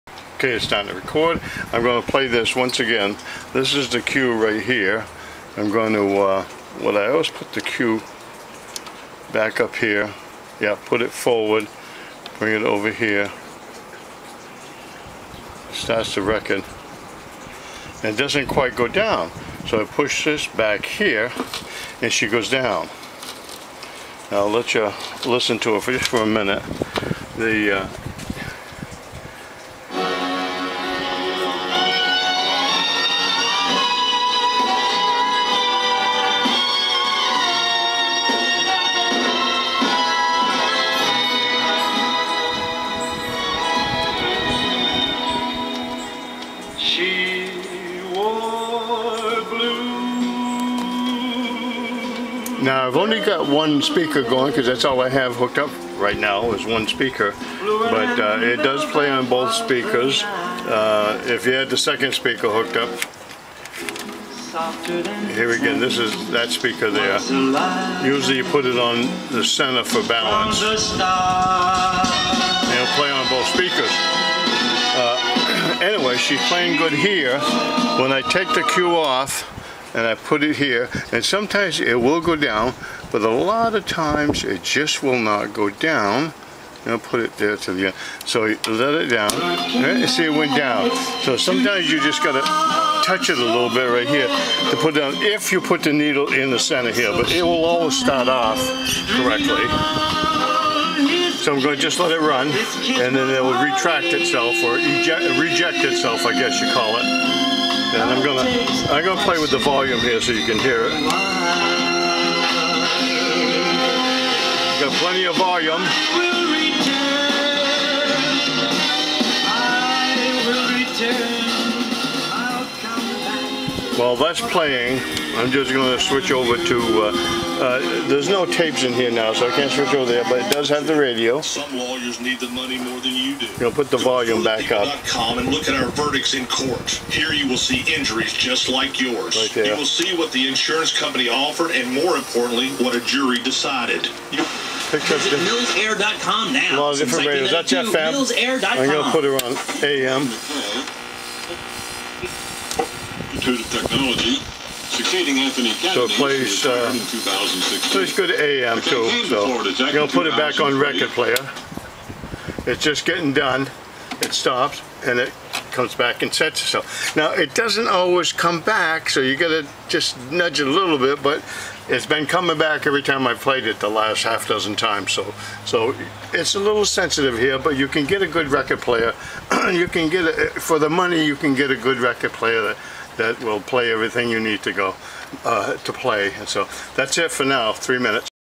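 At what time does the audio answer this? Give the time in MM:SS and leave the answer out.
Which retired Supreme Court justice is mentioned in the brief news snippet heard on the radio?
02:35.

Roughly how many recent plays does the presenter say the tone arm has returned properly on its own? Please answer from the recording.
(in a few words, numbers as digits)
half dozen.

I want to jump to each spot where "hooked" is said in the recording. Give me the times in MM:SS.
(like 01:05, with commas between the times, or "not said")
00:55, 01:02.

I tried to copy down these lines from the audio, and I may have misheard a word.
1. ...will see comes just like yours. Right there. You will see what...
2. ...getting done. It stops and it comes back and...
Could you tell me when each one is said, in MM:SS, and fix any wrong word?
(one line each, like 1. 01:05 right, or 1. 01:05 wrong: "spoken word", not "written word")
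1. 02:17 wrong: "injuries", not "comes"
2. 02:43 right.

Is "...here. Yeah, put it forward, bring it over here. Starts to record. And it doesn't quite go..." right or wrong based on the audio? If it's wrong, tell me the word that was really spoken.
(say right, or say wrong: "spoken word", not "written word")
right.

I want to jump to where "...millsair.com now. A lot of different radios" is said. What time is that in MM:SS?
02:25.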